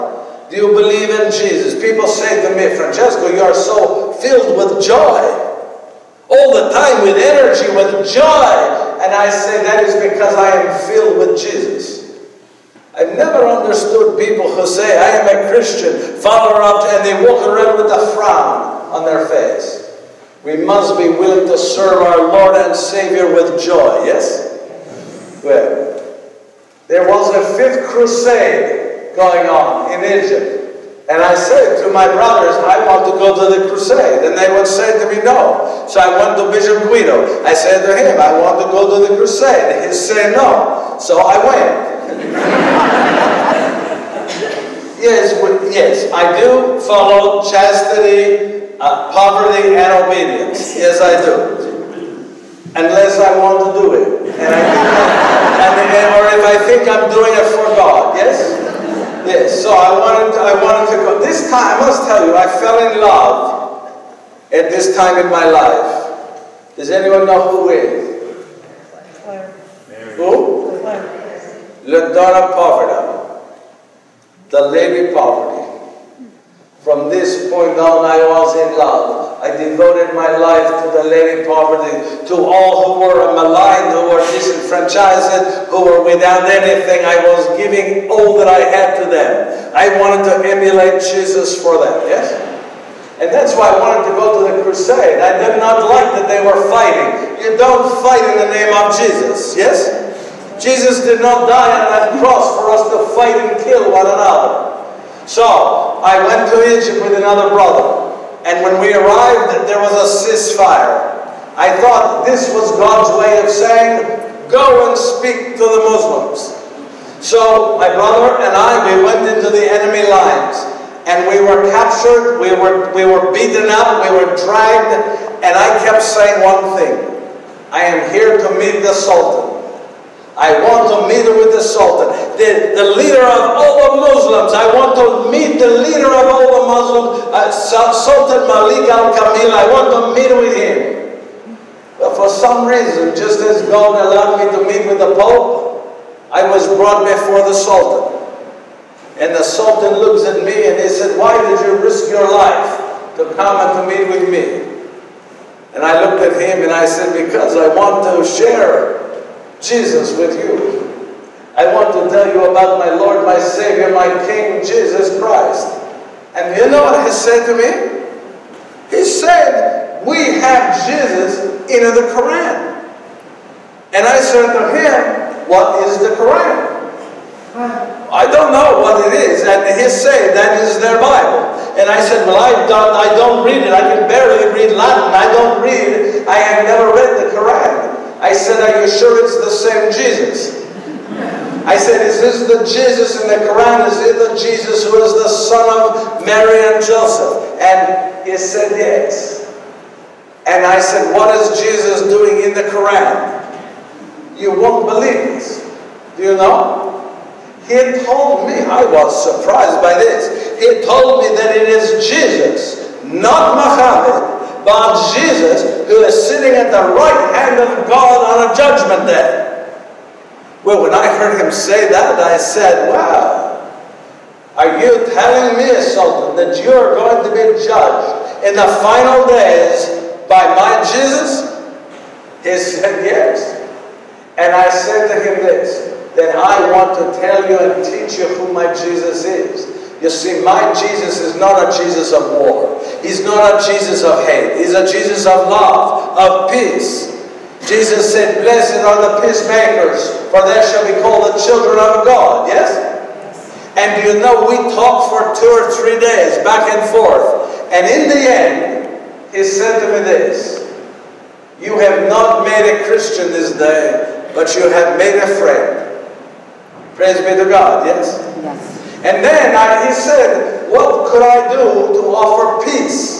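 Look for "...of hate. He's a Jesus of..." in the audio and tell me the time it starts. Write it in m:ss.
4:04.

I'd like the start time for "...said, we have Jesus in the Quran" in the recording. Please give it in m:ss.
2:49.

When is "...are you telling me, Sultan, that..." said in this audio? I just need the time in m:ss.
3:44.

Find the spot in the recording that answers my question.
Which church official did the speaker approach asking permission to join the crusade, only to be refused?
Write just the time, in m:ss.
0:36.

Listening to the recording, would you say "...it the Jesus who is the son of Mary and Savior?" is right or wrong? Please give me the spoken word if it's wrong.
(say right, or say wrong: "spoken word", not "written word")
wrong: "Joseph", not "Savior".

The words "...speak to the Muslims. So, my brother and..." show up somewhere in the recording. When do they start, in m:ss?
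1:54.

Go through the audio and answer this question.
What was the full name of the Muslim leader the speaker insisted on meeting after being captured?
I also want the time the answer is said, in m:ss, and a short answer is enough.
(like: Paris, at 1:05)
Sultan Malik al Kamil, at 2:17.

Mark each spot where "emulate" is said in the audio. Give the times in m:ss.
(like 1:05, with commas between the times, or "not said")
1:30.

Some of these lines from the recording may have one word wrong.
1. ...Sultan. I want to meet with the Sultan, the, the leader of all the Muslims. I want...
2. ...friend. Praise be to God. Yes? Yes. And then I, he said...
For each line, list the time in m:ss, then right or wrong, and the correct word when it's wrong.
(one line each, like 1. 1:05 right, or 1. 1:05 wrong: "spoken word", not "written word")
1. 2:08 right
2. 4:25 right.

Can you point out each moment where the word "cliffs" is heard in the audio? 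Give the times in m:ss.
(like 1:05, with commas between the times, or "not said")
not said.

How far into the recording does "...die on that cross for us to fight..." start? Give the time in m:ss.
1:41.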